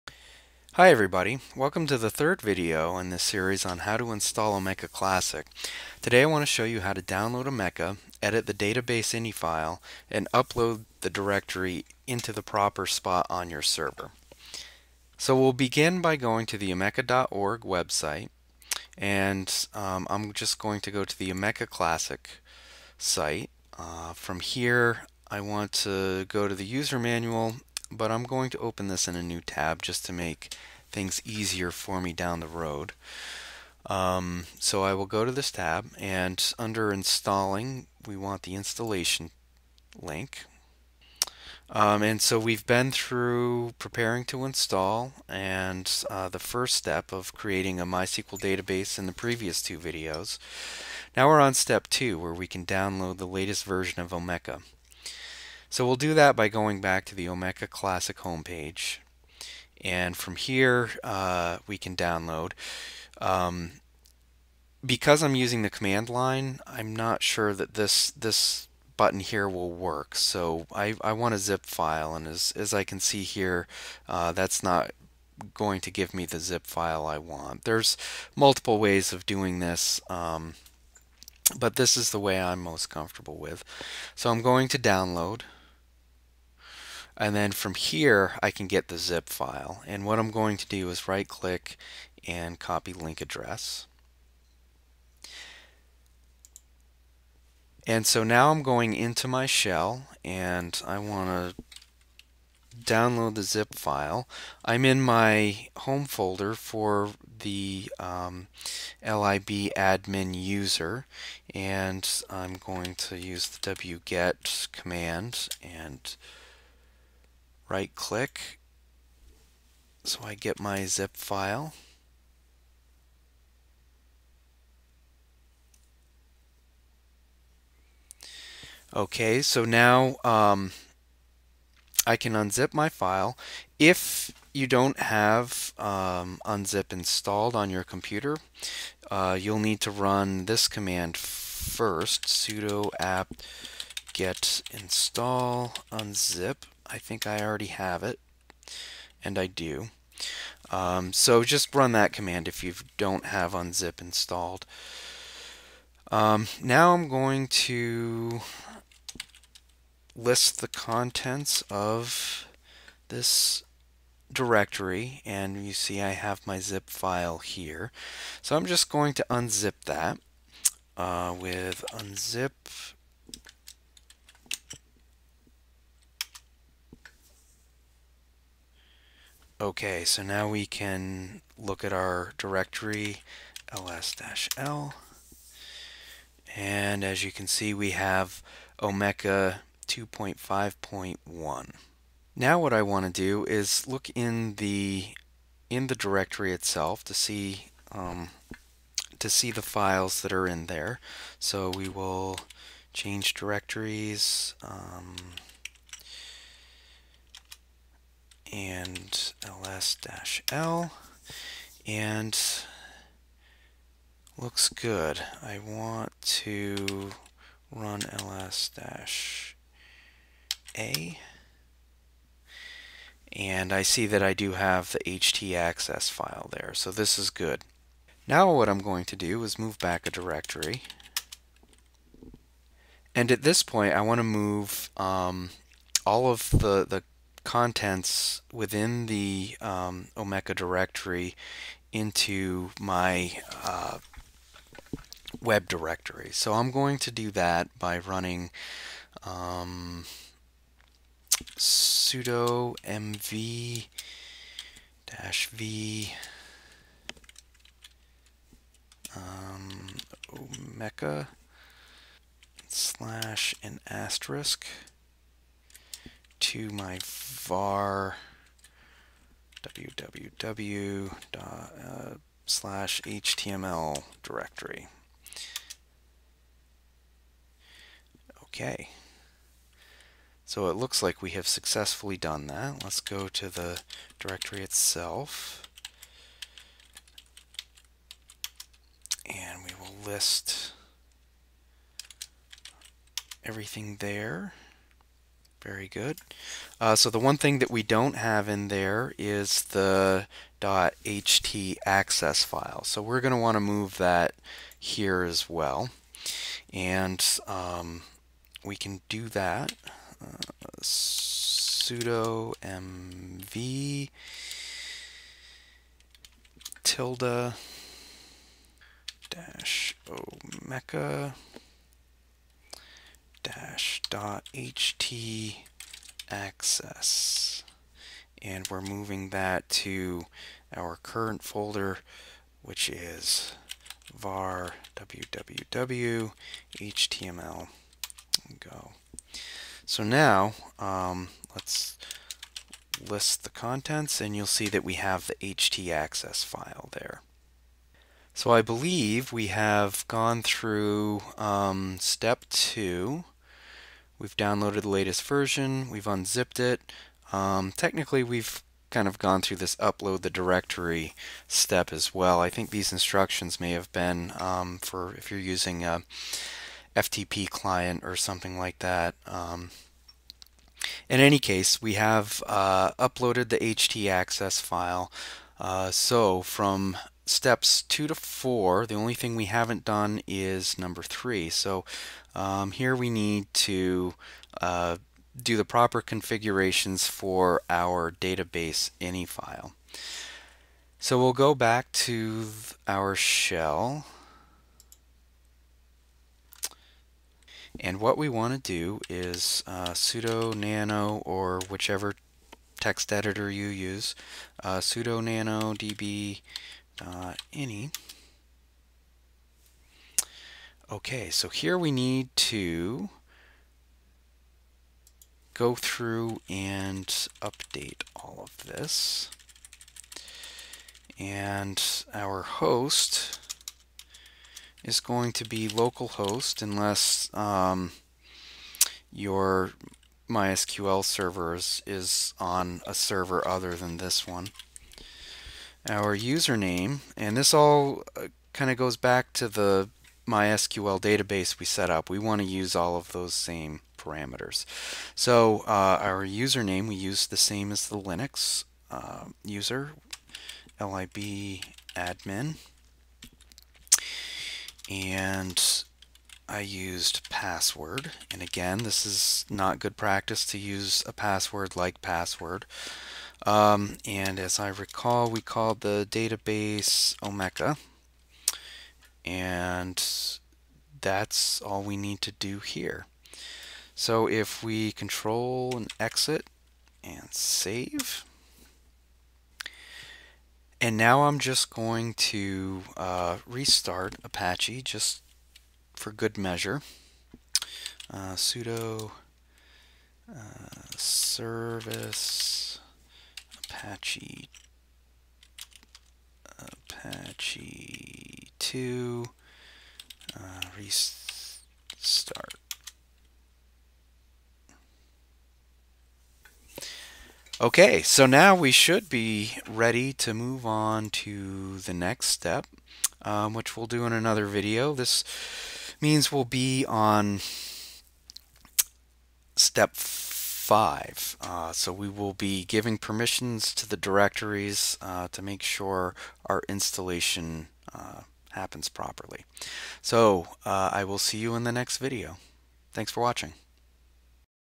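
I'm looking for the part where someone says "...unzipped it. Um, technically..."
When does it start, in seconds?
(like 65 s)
356 s.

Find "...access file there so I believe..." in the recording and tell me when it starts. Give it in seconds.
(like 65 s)
345 s.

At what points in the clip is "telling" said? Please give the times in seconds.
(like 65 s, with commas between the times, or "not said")
not said.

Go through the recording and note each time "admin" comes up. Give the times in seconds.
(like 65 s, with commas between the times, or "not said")
109 s, 451 s.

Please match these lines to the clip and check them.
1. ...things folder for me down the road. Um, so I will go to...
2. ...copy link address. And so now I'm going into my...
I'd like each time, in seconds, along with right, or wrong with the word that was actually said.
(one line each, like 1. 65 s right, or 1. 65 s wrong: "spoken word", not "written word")
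1. 30 s wrong: "easier", not "folder"
2. 92 s right.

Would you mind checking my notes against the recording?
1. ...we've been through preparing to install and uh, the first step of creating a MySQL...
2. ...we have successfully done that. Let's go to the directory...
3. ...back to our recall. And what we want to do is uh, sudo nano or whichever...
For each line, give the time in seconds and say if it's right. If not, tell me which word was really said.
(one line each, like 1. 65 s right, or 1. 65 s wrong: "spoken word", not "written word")
1. 42 s right
2. 281 s right
3. 391 s wrong: "shell", not "recall".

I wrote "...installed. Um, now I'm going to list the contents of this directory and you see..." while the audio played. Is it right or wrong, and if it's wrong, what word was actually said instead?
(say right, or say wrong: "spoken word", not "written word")
right.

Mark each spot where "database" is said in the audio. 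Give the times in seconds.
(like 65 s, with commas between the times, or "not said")
8 s, 48 s, 388 s, 441 s, 466 s.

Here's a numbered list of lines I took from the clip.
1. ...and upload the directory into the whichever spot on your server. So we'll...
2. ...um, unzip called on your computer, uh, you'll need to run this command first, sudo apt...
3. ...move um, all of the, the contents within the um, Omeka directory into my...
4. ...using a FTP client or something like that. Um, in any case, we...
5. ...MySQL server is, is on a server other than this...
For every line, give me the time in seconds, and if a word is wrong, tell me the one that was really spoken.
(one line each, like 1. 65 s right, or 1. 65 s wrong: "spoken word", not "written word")
1. 10 s wrong: "proper", not "whichever"
2. 135 s wrong: "installed", not "called"
3. 234 s right
4. 365 s right
5. 430 s right.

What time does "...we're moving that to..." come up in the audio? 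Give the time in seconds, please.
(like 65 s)
328 s.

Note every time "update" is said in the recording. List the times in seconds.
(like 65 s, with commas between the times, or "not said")
417 s.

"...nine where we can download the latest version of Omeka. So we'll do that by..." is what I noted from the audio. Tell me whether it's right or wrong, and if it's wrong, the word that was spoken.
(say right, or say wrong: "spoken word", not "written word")
wrong: "two", not "nine".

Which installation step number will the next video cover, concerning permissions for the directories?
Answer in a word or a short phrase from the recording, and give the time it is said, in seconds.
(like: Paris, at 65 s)
5, at 519 s.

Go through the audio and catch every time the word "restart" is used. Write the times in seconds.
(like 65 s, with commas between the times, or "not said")
483 s, 500 s.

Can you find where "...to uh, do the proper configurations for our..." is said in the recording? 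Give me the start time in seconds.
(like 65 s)
383 s.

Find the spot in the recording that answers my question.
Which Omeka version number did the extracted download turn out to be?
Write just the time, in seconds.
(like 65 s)
188 s.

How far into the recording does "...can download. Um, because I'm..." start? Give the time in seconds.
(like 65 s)
61 s.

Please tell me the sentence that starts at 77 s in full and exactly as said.
There's multiple ways of doing this, um, but this is the way I'm most comfortable with.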